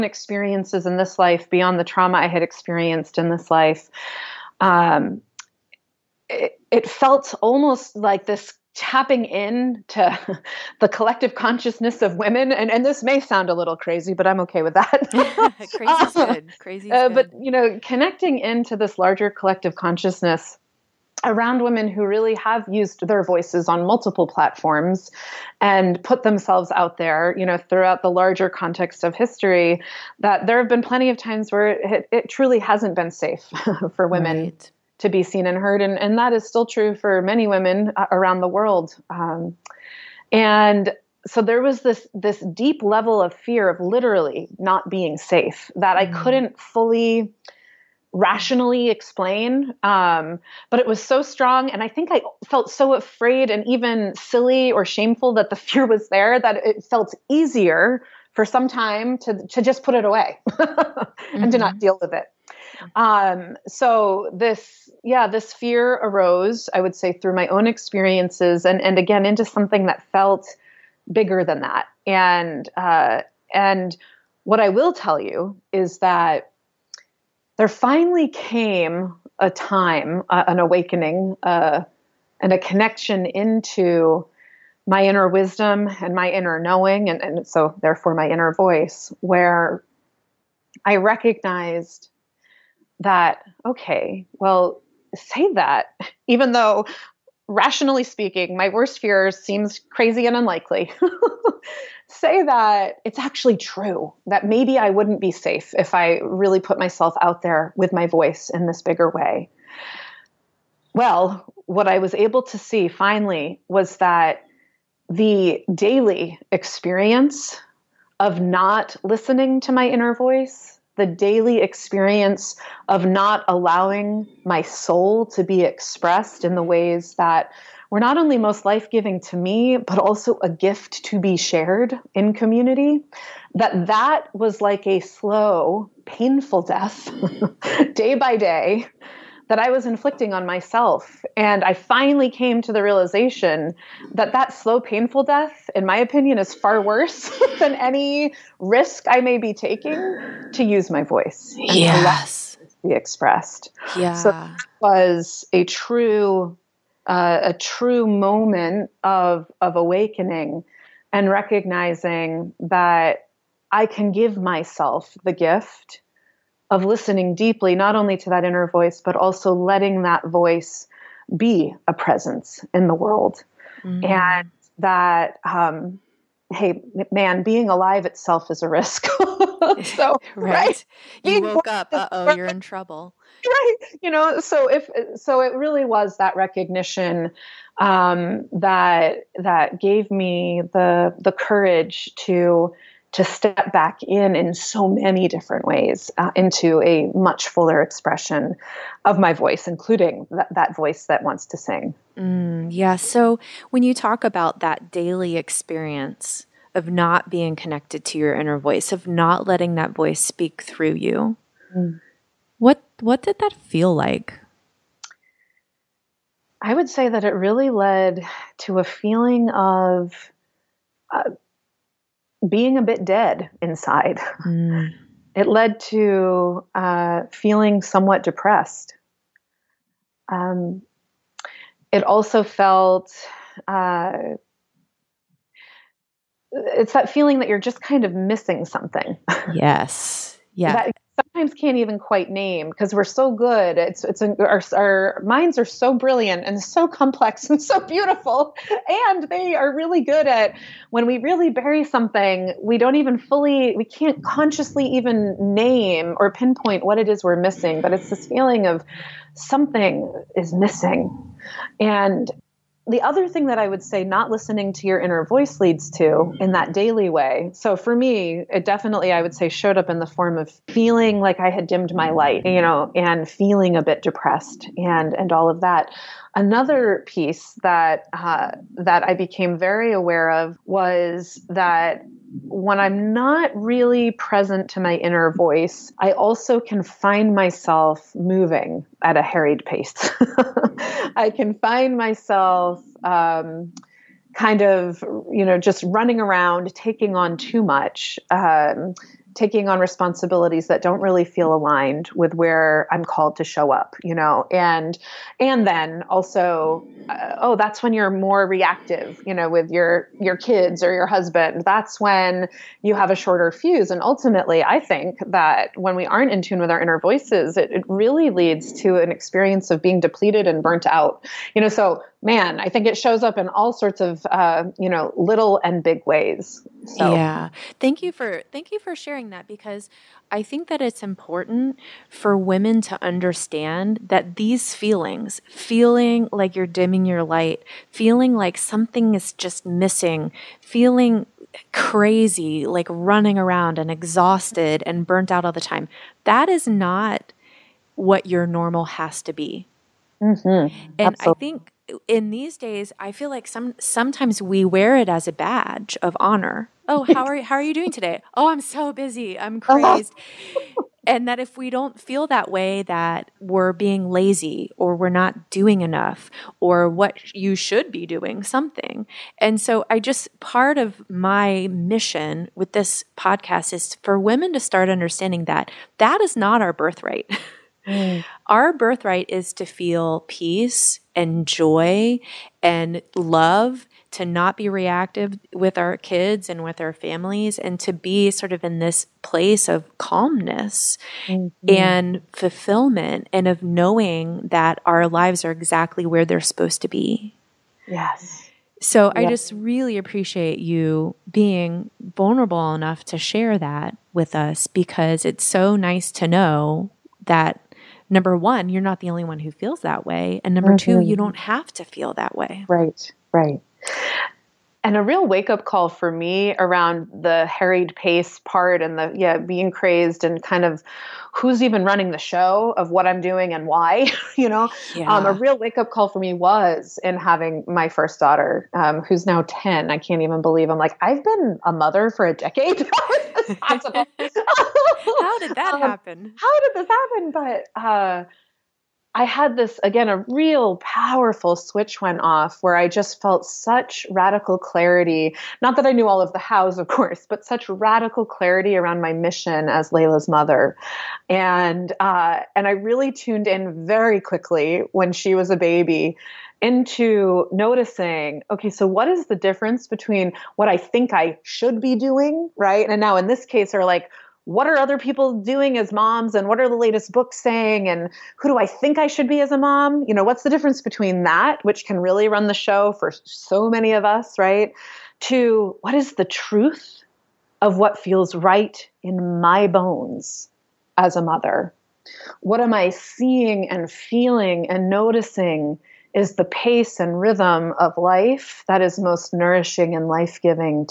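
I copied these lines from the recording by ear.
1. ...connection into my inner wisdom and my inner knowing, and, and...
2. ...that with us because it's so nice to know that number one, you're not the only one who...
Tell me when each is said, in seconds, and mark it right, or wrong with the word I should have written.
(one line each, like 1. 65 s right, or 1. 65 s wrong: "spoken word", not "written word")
1. 82 s right
2. 403 s right.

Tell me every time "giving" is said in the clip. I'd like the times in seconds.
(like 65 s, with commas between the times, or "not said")
128 s, 490 s.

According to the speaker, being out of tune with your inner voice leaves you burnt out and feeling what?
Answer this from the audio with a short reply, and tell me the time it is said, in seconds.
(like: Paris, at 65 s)
Depleted, at 320 s.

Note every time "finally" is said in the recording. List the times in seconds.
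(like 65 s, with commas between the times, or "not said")
77 s, 112 s, 141 s.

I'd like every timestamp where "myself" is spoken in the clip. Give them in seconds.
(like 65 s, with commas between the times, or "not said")
106 s, 140 s, 164 s, 287 s, 291 s.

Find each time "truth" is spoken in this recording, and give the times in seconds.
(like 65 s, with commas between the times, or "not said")
476 s.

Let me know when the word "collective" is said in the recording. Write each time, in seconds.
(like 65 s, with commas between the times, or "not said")
10 s, 19 s.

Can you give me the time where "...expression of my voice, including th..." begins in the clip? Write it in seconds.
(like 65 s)
197 s.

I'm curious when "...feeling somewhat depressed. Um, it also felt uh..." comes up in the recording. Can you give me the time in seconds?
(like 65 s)
227 s.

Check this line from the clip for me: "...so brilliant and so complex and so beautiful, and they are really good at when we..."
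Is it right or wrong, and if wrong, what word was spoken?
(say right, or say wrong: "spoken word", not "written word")
right.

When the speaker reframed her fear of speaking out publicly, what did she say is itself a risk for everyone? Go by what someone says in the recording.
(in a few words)
Being alive.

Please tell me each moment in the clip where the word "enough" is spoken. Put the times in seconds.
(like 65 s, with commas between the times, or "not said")
365 s, 402 s.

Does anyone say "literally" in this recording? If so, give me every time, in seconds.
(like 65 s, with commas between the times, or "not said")
43 s.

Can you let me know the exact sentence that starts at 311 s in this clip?
That's when you have a shorter fuse.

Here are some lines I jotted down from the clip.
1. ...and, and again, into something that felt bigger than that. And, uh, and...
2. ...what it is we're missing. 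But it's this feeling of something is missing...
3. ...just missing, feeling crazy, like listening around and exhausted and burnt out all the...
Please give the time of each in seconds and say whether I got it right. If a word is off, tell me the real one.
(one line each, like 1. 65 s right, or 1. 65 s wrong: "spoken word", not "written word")
1. 68 s right
2. 256 s right
3. 339 s wrong: "running", not "listening".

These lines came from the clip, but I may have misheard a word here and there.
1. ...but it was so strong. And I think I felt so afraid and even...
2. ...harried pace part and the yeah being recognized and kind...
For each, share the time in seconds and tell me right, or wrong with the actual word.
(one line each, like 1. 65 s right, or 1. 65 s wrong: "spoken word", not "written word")
1. 50 s right
2. 417 s wrong: "crazed", not "recognized".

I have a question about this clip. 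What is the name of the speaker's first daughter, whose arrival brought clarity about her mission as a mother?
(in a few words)
Layla.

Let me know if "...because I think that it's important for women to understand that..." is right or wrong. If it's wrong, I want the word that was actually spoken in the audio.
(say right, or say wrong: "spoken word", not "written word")
right.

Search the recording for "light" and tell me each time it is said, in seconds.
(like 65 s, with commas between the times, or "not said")
272 s, 337 s.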